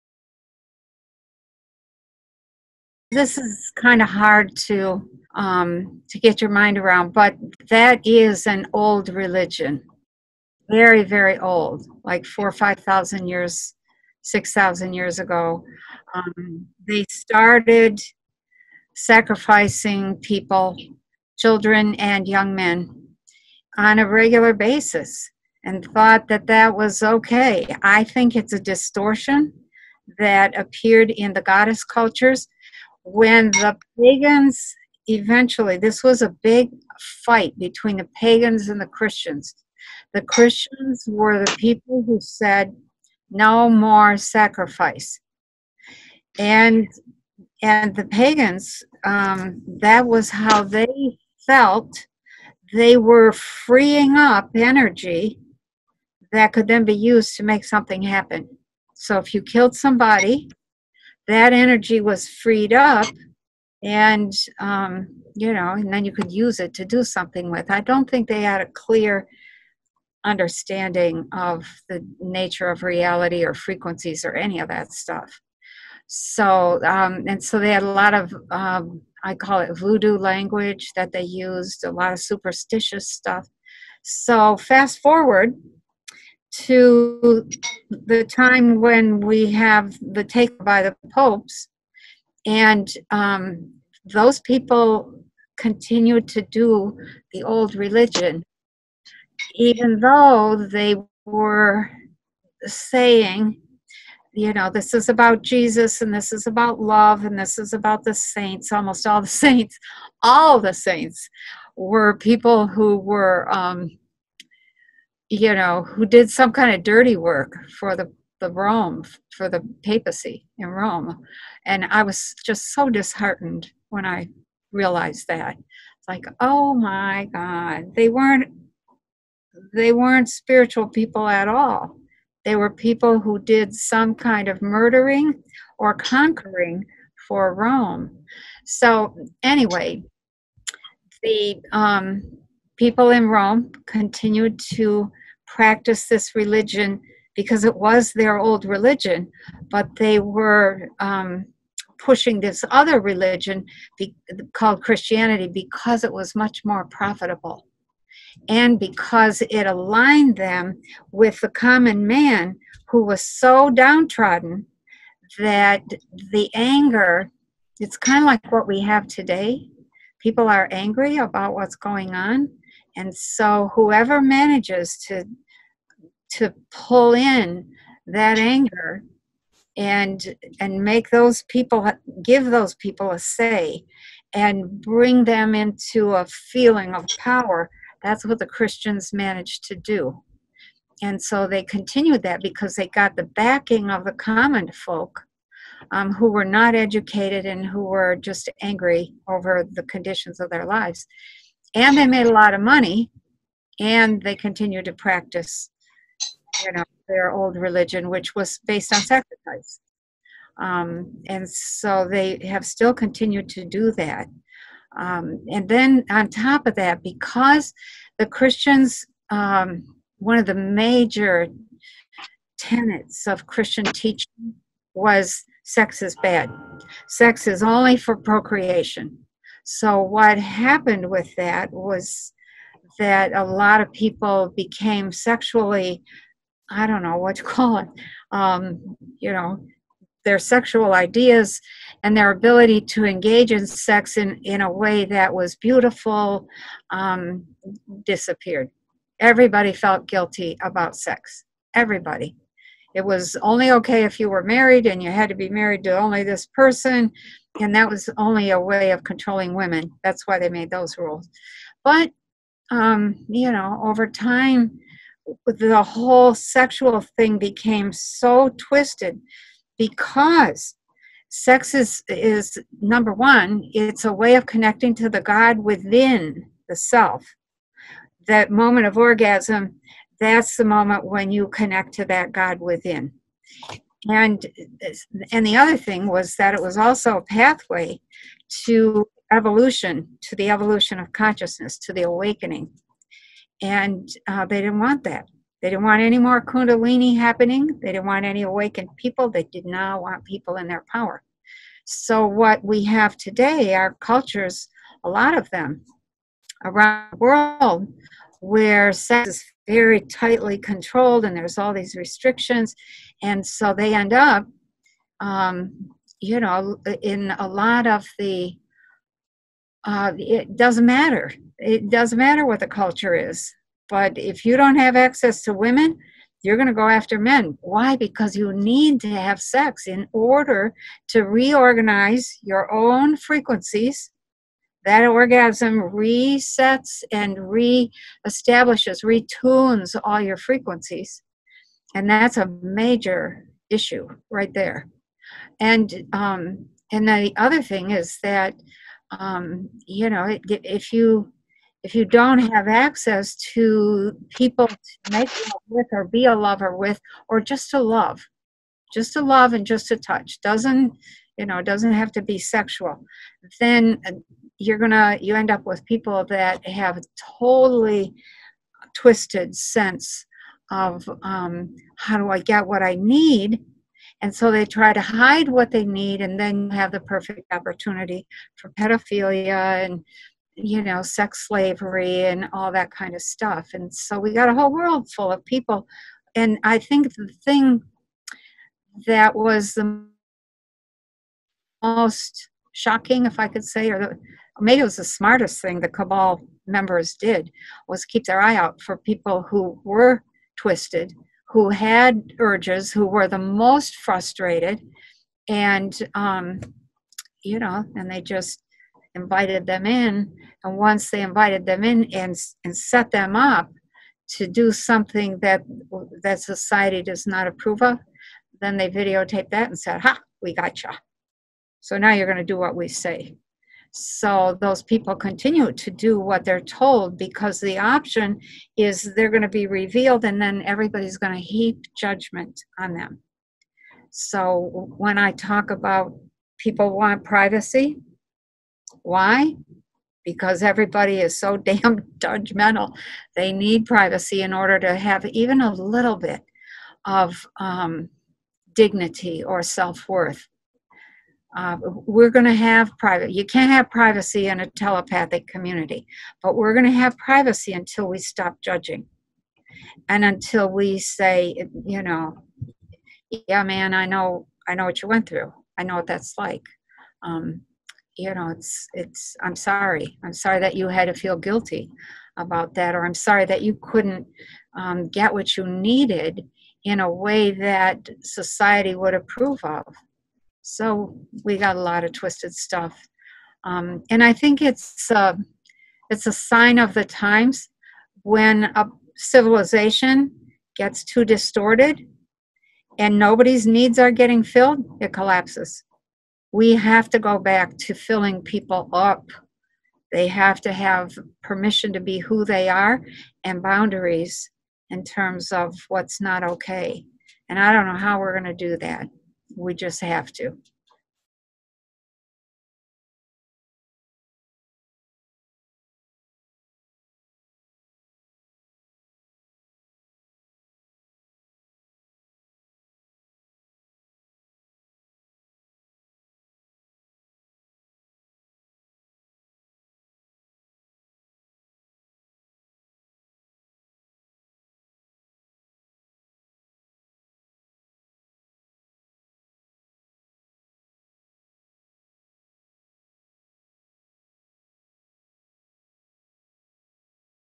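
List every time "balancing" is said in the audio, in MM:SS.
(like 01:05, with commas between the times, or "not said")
not said.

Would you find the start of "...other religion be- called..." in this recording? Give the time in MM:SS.
02:32.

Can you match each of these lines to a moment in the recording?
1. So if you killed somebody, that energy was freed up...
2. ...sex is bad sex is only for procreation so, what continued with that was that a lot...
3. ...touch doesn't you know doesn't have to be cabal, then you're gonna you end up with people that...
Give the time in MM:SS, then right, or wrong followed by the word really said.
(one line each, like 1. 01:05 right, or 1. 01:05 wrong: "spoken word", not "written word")
1. 00:58 right
2. 03:45 wrong: "happened", not "continued"
3. 05:59 wrong: "sexual", not "cabal".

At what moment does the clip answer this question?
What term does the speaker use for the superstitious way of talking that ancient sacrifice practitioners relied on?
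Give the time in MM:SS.
01:19.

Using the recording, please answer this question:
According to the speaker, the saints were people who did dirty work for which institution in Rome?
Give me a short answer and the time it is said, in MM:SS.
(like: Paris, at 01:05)
the papacy, at 01:59.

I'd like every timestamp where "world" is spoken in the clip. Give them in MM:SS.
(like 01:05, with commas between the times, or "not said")
05:07, 06:24.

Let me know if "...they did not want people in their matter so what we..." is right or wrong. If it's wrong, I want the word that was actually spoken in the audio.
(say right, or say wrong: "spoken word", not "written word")
wrong: "power", not "matter".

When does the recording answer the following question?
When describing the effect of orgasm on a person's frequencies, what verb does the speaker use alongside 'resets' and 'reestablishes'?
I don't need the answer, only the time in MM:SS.
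05:39.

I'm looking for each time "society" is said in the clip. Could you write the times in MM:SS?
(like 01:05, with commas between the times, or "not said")
06:56, 07:58.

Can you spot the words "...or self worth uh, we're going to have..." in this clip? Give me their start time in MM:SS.
07:29.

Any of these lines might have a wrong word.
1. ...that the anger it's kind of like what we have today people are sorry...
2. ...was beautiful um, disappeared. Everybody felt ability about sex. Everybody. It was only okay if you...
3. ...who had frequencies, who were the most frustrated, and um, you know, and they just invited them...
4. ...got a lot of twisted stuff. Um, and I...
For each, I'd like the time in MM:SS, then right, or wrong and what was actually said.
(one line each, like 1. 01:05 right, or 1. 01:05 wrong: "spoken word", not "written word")
1. 02:45 wrong: "angry", not "sorry"
2. 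04:05 wrong: "guilty", not "ability"
3. 06:41 wrong: "urges", not "frequencies"
4. 08:01 right.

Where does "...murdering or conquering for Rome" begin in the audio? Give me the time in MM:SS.
02:14.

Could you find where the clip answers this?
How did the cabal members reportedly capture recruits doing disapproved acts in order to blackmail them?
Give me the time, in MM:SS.
06:58.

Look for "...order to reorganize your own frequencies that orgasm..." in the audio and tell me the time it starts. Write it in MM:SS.
05:30.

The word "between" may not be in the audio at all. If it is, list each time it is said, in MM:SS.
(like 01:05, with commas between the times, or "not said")
00:37.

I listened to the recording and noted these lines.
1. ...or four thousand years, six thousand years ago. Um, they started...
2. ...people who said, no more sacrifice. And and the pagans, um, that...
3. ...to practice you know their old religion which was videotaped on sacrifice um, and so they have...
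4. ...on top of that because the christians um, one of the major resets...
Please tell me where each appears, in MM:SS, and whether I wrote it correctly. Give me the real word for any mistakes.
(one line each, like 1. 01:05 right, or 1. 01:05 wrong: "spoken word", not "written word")
1. 00:12 wrong: "five", not "four"
2. 00:41 right
3. 03:24 wrong: "based", not "videotaped"
4. 03:36 wrong: "tenets", not "resets".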